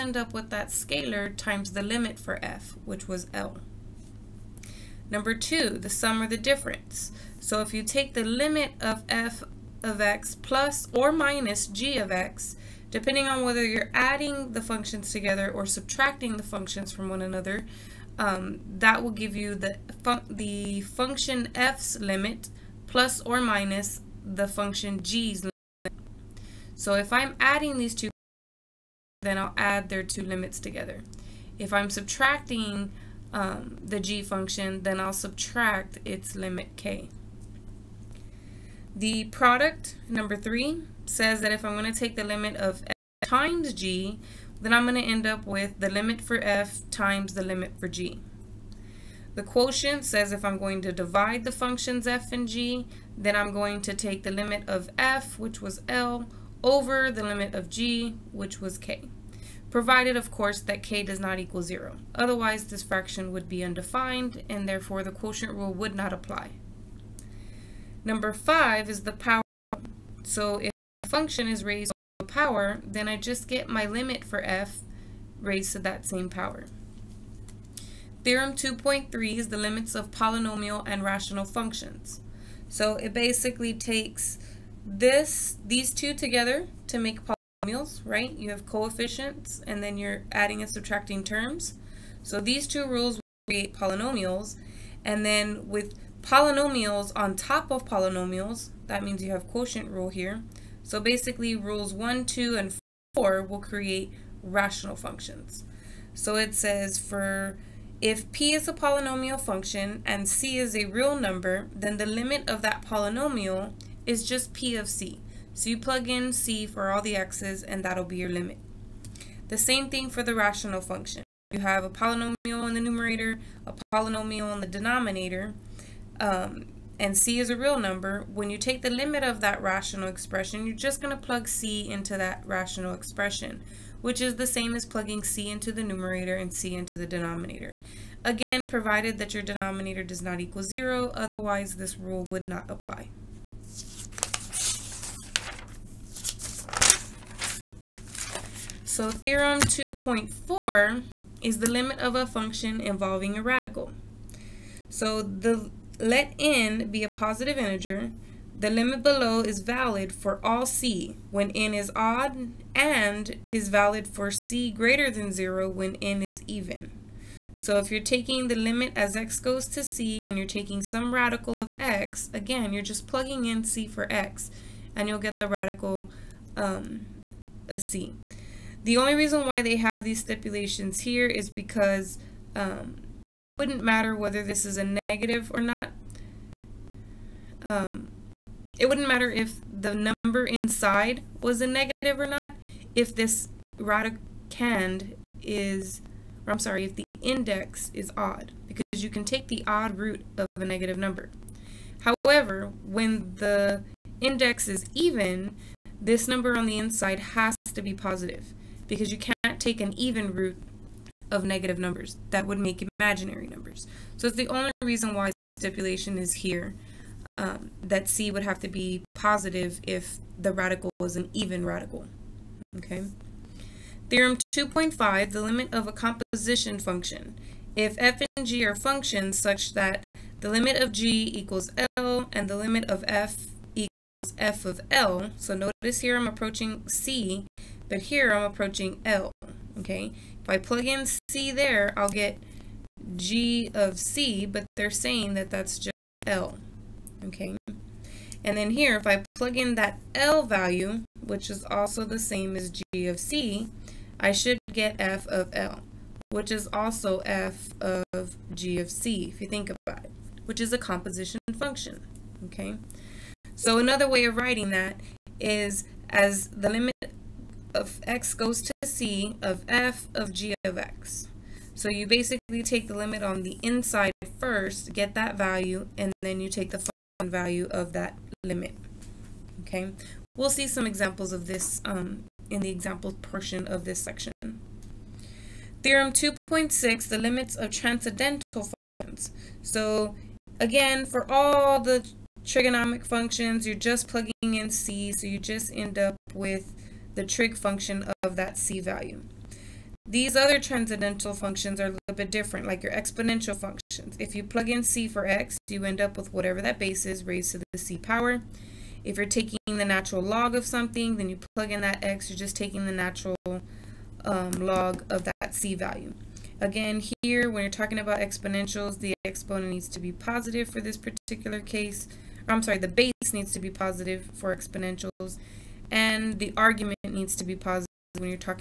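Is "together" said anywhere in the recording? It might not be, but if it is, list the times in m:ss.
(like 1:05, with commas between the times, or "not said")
0:15, 0:30, 1:26.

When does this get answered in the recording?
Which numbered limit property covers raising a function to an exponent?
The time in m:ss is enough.
1:08.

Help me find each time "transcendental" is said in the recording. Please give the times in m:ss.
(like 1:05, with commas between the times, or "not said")
4:47, 5:00.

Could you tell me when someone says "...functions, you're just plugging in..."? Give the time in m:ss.
4:53.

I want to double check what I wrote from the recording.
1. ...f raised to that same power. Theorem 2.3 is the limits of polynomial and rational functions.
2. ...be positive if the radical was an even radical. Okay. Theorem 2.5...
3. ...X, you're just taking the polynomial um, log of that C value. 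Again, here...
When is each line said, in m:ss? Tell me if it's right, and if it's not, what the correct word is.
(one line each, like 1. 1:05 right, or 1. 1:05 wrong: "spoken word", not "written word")
1. 1:14 right
2. 3:38 right
3. 5:12 wrong: "natural", not "polynomial".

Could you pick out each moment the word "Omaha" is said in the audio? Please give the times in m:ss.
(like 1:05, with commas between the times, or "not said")
not said.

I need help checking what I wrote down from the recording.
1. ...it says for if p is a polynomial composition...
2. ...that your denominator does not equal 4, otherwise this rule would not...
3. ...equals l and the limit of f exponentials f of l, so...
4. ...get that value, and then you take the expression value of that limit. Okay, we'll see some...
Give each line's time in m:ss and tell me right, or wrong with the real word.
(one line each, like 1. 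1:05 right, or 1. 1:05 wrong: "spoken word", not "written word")
1. 1:46 wrong: "function", not "composition"
2. 2:19 wrong: "0", not "4"
3. 3:51 wrong: "equals", not "exponentials"
4. 4:34 wrong: "function", not "expression".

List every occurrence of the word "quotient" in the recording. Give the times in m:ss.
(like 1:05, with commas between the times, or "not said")
0:49, 1:05, 1:39.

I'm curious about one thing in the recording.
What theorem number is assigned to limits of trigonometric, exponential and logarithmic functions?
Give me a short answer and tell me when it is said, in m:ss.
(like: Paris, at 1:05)
2.6, at 4:45.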